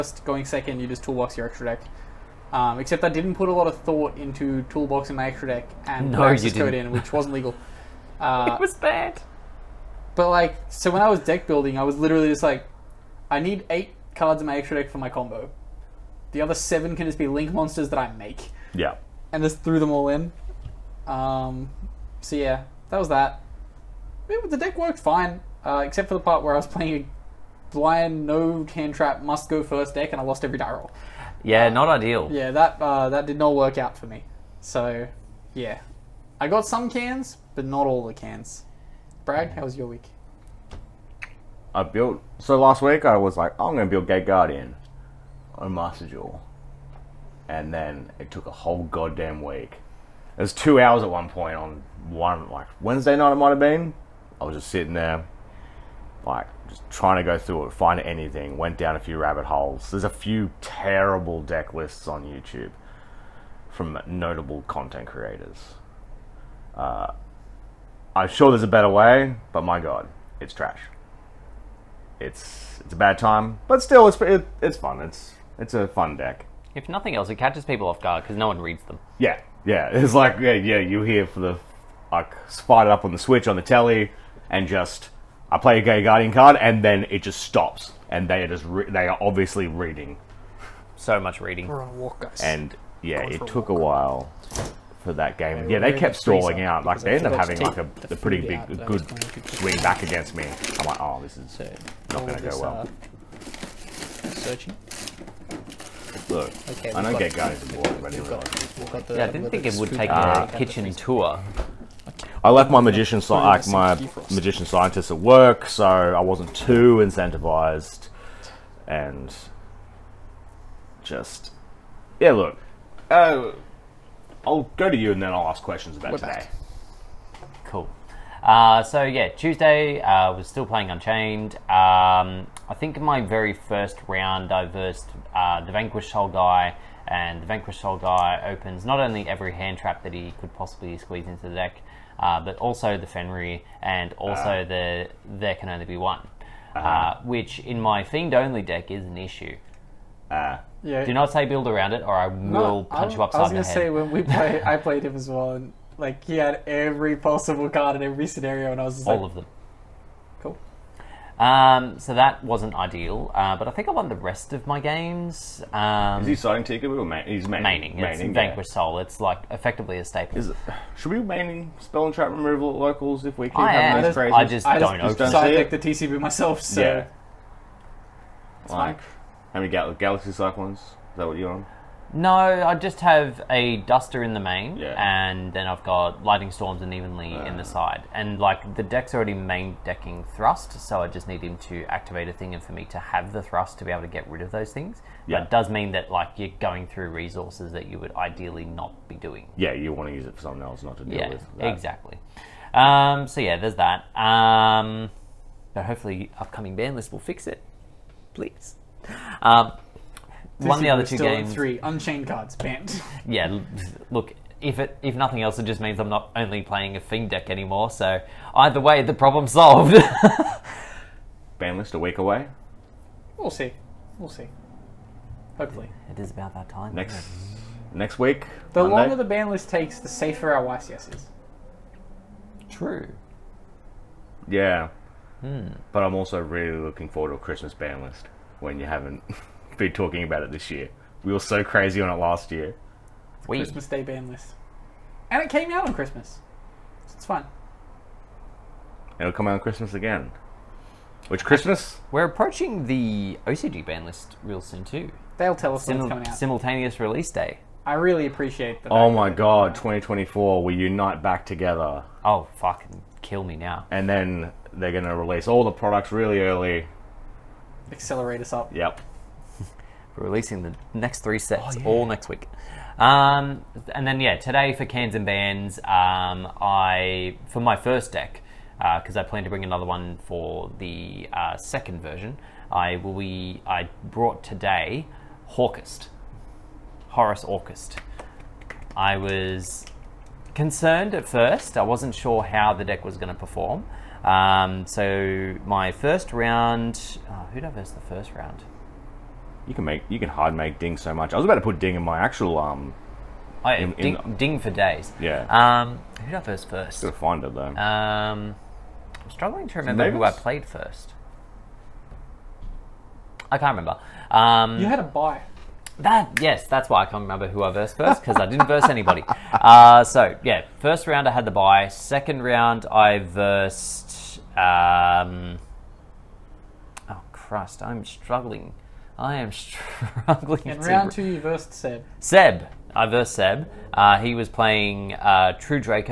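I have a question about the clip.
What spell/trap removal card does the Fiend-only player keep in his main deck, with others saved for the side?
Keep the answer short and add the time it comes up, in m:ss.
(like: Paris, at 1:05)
Duster, at 3:03.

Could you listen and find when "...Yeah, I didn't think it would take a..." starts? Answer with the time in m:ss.
1:49.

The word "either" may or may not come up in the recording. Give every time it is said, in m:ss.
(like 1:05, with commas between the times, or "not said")
3:38.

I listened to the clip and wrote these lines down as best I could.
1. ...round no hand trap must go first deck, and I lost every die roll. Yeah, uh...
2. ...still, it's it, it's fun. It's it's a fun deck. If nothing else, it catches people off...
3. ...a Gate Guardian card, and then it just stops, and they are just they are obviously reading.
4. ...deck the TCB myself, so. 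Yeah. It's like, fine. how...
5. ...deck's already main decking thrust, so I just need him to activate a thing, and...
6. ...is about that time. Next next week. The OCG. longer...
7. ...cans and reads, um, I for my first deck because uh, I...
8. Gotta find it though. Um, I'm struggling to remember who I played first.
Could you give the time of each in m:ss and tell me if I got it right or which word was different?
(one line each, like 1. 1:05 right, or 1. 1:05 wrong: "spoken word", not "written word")
1. 0:27 wrong: "blind", not "round"
2. 1:13 right
3. 1:25 right
4. 2:55 right
5. 3:08 right
6. 3:46 wrong: "Monday", not "OCG"
7. 4:34 wrong: "bands", not "reads"
8. 5:07 right.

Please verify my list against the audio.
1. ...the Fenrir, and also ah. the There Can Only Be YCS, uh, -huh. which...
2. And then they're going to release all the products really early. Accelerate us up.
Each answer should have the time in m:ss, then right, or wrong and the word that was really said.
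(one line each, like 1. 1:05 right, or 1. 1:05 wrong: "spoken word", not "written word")
1. 2:22 wrong: "One", not "YCS"
2. 4:23 right.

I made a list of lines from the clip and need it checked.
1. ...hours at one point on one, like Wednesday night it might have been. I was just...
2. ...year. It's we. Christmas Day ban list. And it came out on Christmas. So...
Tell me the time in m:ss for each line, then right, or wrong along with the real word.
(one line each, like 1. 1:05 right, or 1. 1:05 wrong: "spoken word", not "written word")
1. 0:50 right
2. 4:02 right.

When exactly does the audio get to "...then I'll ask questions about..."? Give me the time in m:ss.
2:05.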